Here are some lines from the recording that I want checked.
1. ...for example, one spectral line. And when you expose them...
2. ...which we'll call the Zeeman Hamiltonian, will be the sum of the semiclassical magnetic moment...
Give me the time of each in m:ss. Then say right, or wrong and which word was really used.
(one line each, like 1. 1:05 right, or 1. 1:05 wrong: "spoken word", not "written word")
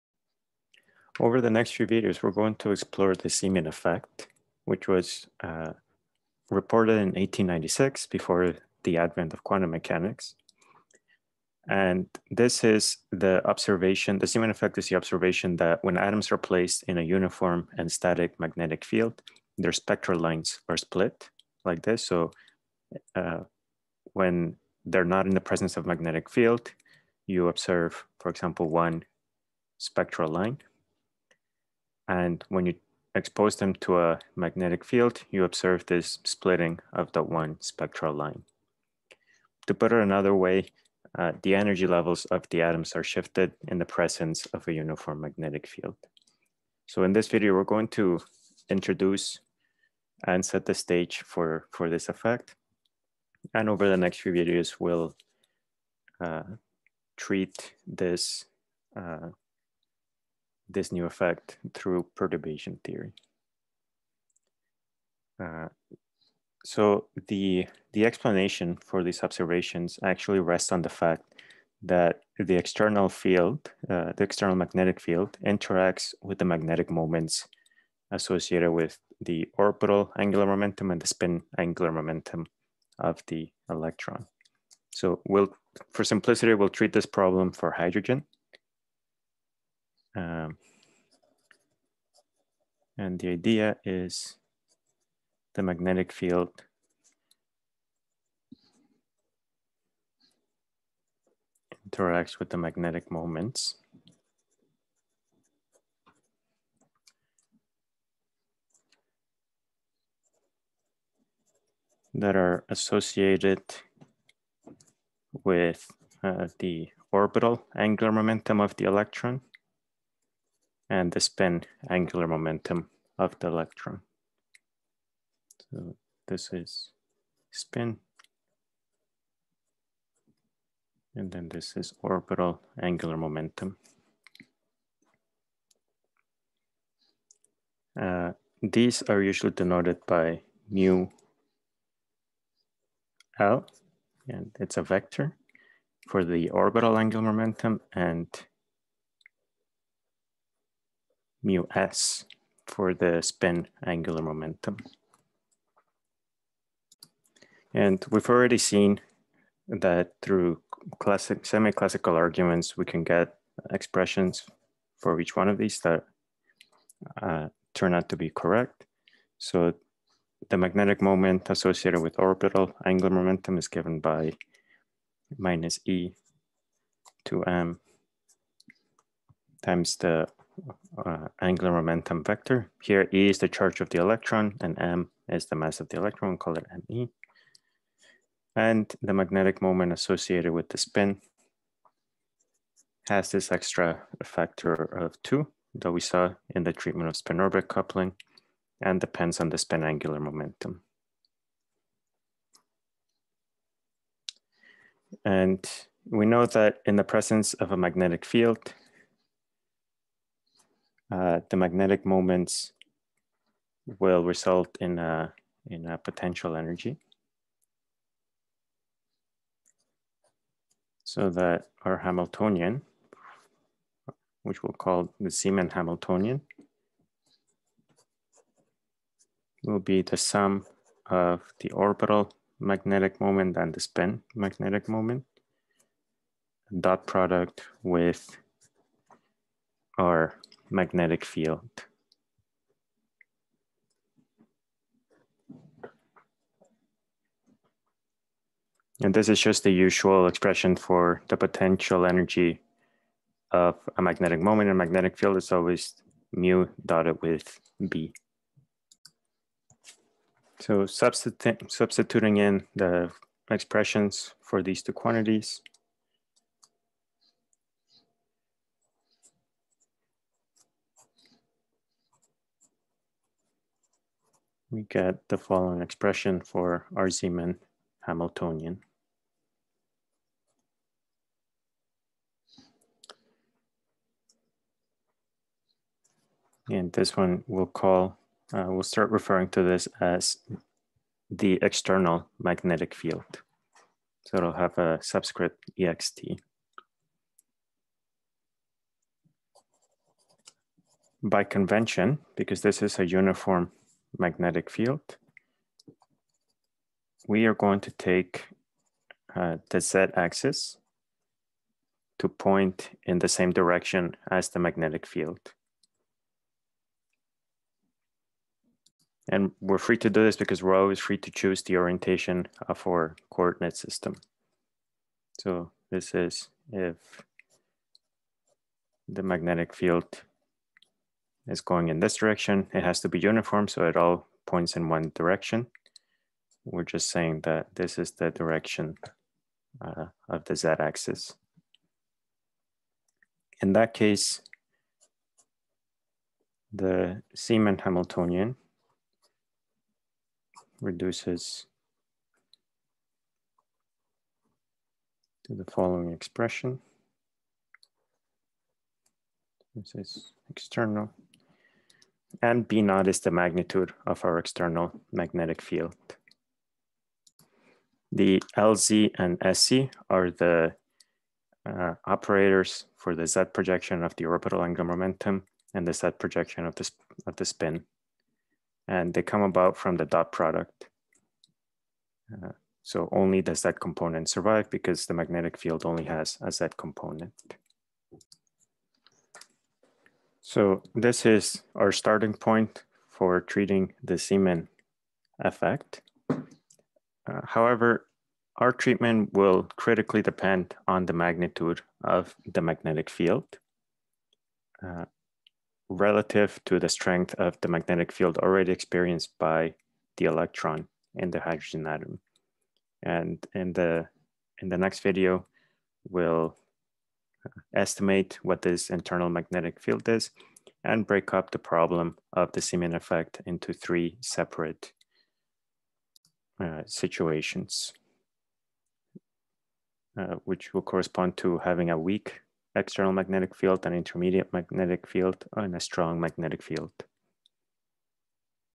1. 0:28 right
2. 3:44 wrong: "orbital", not "semiclassical".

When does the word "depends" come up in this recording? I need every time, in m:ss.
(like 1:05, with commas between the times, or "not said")
3:18, 6:40.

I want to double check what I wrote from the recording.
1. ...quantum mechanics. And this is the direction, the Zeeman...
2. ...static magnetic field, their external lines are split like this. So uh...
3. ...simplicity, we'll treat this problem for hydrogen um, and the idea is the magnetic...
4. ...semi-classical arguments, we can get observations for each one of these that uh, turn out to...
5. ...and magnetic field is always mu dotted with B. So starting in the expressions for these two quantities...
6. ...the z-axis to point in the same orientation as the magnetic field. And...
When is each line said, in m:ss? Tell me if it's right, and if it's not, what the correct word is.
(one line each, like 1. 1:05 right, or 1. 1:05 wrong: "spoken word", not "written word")
1. 0:09 wrong: "observation", not "direction"
2. 0:17 wrong: "spectral", not "external"
3. 1:26 right
4. 2:41 wrong: "expressions", not "observations"
5. 4:14 wrong: "substituting", not "starting"
6. 5:09 wrong: "direction", not "orientation".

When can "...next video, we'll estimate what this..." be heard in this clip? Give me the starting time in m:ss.
6:54.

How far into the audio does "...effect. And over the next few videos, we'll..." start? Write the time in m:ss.
0:52.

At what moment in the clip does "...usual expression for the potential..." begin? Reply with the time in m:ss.
4:09.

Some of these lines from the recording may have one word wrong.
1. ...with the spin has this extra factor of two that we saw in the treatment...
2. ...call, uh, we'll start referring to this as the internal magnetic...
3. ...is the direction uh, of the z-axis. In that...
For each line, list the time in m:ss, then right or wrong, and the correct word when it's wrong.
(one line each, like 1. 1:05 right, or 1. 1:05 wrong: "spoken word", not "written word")
1. 3:10 right
2. 4:47 wrong: "external", not "internal"
3. 5:37 right.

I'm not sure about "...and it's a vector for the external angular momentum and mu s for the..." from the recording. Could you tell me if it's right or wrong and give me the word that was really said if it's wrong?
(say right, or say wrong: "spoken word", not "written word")
wrong: "orbital", not "external".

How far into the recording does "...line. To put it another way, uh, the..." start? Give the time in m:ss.
0:38.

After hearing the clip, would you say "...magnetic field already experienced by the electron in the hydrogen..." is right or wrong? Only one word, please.
right.